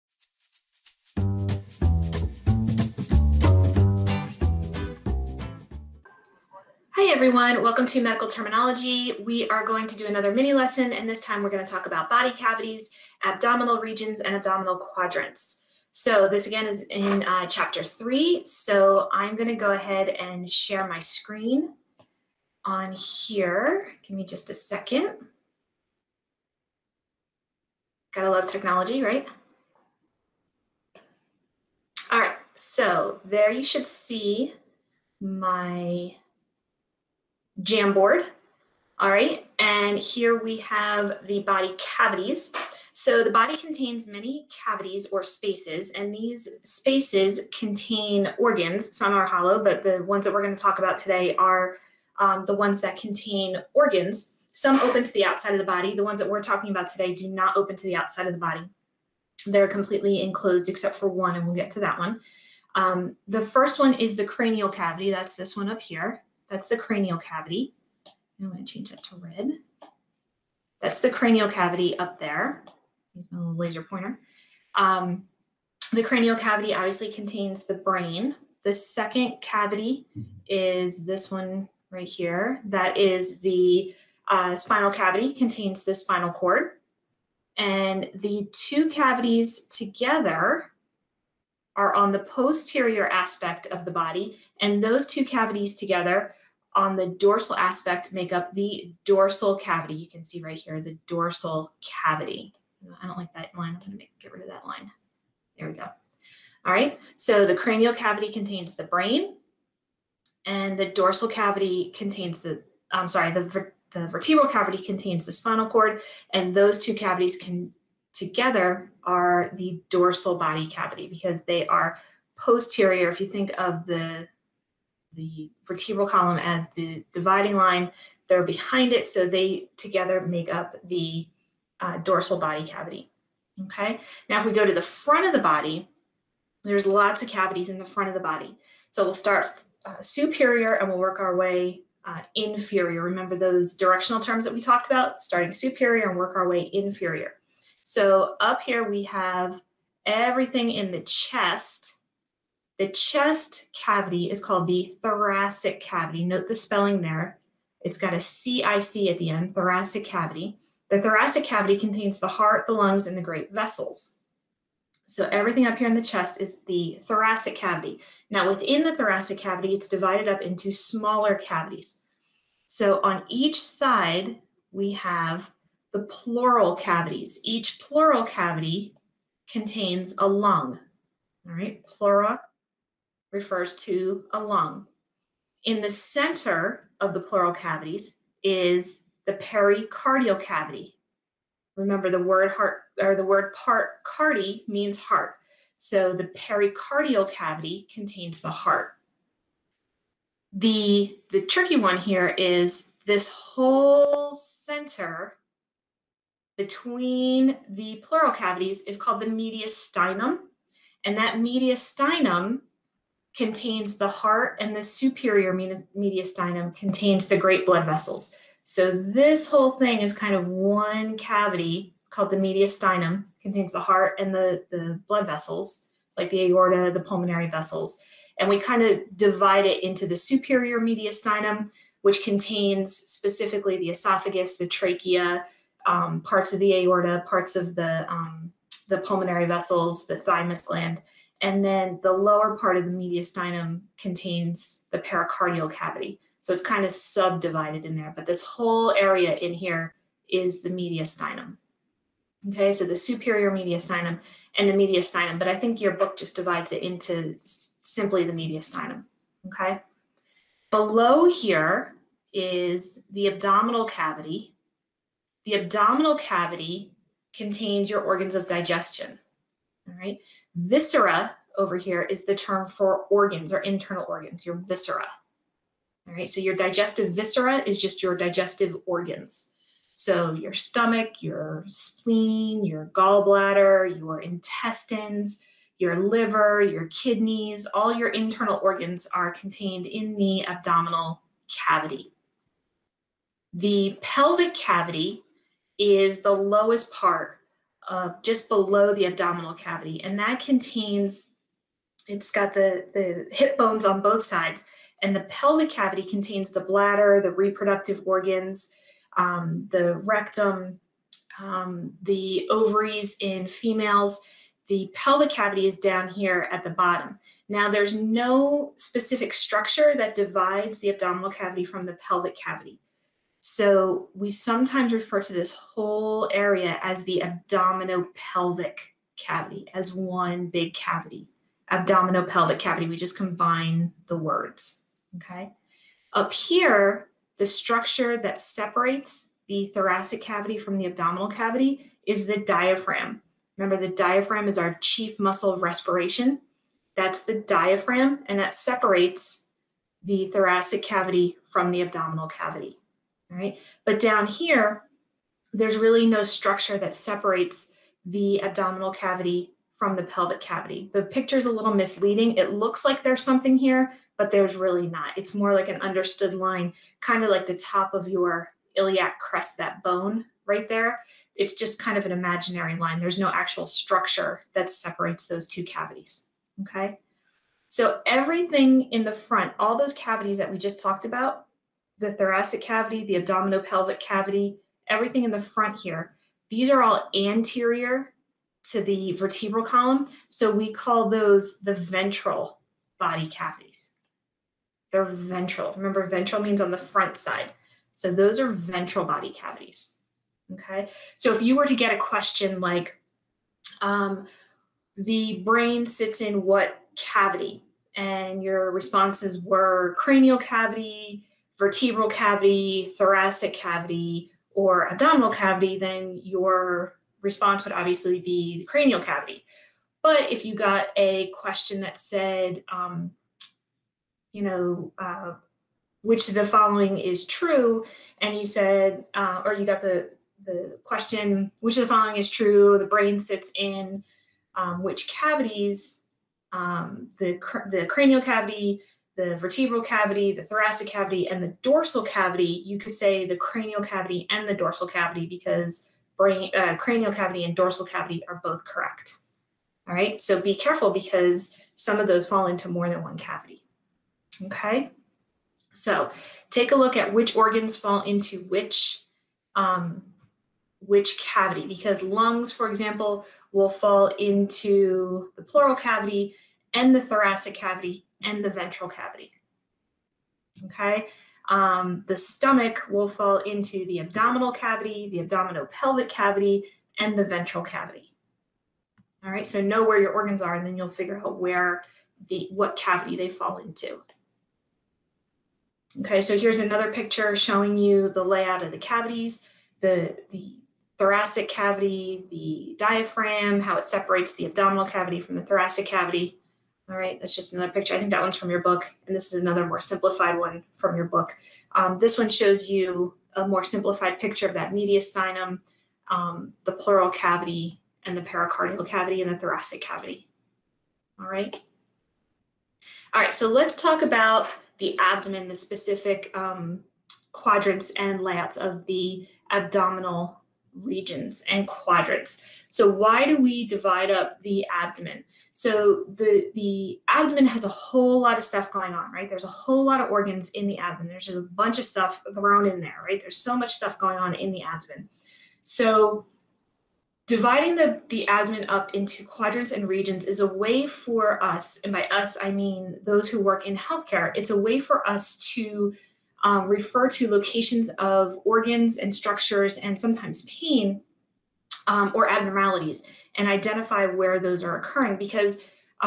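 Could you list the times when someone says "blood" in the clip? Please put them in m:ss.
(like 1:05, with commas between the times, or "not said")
3:37, 3:45.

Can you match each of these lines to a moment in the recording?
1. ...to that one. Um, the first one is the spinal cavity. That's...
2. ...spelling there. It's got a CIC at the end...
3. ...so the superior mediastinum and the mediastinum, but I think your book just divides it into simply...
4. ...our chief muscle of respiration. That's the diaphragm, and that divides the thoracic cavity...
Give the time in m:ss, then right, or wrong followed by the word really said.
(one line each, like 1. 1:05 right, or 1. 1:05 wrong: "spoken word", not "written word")
1. 1:01 wrong: "cranial", not "spinal"
2. 2:36 right
3. 4:12 right
4. 5:44 wrong: "separates", not "divides".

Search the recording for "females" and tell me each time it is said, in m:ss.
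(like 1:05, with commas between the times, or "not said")
5:13.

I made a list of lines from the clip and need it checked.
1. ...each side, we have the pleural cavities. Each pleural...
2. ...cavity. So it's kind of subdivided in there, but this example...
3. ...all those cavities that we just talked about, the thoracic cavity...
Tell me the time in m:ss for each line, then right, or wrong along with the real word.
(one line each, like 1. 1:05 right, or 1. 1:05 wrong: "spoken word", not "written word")
1. 2:53 right
2. 4:05 wrong: "whole", not "example"
3. 6:19 right.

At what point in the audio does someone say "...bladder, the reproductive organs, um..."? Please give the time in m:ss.
5:06.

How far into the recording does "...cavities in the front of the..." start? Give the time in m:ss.
2:17.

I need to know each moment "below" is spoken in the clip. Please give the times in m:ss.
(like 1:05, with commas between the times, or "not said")
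4:20, 4:58.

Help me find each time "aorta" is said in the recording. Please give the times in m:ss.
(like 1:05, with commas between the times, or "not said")
3:46, 3:56.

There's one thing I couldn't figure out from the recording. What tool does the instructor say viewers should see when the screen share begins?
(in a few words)
Jamboard.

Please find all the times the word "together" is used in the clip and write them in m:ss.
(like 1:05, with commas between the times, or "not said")
1:29, 1:35, 1:58, 2:09.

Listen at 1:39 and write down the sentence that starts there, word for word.
You can see right here the dorsal cavity.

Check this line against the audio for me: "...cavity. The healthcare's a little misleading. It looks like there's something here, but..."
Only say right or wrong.
wrong.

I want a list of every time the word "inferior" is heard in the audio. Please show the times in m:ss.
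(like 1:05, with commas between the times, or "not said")
2:22, 2:26.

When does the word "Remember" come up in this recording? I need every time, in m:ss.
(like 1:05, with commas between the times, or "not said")
2:23, 3:11, 5:43, 6:35.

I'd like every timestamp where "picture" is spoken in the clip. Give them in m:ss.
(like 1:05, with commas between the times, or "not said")
6:01, 8:06, 8:17, 8:24.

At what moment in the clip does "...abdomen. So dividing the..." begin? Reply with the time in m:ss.
8:54.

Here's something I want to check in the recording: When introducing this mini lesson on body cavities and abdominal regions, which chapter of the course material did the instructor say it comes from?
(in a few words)
Chapter 3.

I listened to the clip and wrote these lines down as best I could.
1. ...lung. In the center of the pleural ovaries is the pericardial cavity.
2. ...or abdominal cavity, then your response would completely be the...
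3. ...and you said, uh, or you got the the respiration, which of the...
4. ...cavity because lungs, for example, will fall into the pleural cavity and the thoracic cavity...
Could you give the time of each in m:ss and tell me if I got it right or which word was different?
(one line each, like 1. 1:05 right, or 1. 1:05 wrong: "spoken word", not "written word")
1. 3:04 wrong: "cavities", not "ovaries"
2. 6:54 wrong: "obviously", not "completely"
3. 7:08 wrong: "question", not "respiration"
4. 7:41 right.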